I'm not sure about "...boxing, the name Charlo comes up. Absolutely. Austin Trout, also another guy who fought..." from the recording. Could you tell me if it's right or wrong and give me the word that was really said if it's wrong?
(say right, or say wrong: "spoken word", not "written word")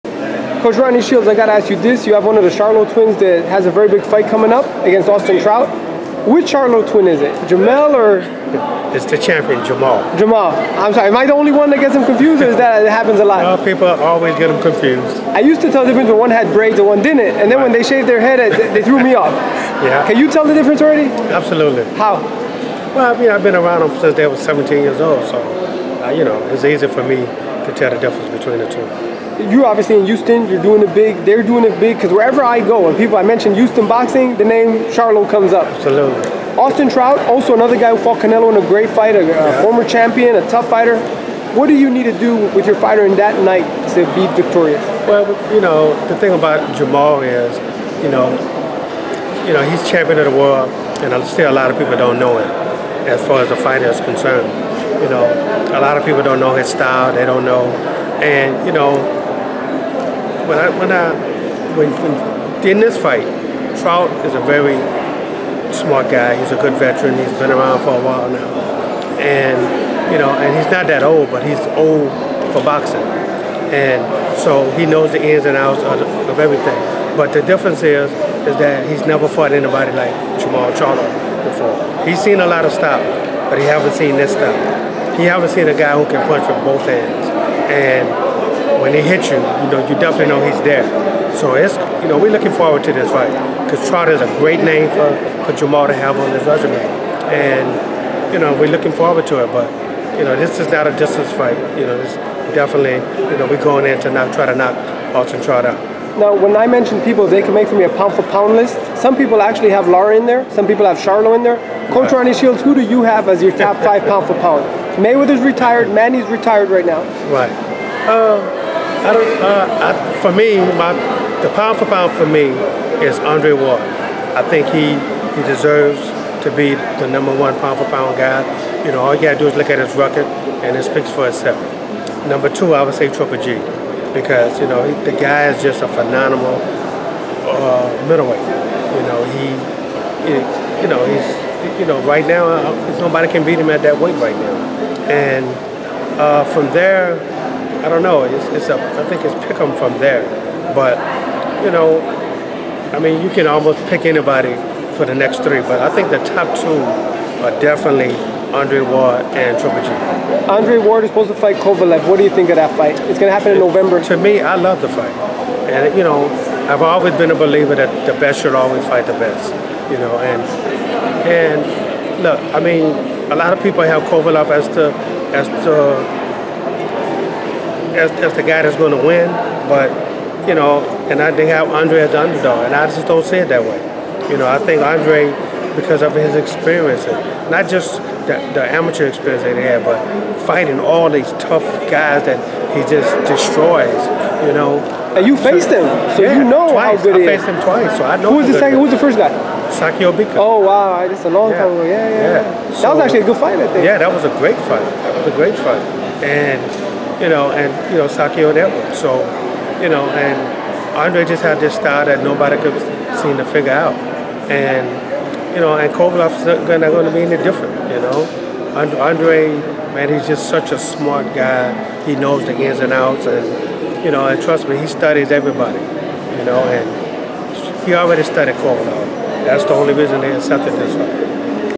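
right.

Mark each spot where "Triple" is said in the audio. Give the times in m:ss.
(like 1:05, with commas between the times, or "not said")
2:13, 2:39.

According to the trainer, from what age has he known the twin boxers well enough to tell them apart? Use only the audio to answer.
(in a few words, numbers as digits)
17.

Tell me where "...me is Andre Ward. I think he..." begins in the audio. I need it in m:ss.
2:02.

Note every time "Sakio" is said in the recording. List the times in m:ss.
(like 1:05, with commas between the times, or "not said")
3:19, 3:28.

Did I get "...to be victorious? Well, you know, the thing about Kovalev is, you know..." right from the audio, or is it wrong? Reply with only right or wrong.
wrong.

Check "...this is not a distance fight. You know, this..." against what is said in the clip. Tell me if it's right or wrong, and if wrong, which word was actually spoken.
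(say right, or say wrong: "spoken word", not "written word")
right.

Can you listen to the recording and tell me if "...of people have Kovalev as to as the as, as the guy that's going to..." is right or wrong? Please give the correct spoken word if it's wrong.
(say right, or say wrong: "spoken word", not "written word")
right.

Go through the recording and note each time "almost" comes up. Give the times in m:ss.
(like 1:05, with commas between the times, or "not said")
2:33.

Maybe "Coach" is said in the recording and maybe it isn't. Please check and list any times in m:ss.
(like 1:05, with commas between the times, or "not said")
0:00, 1:51.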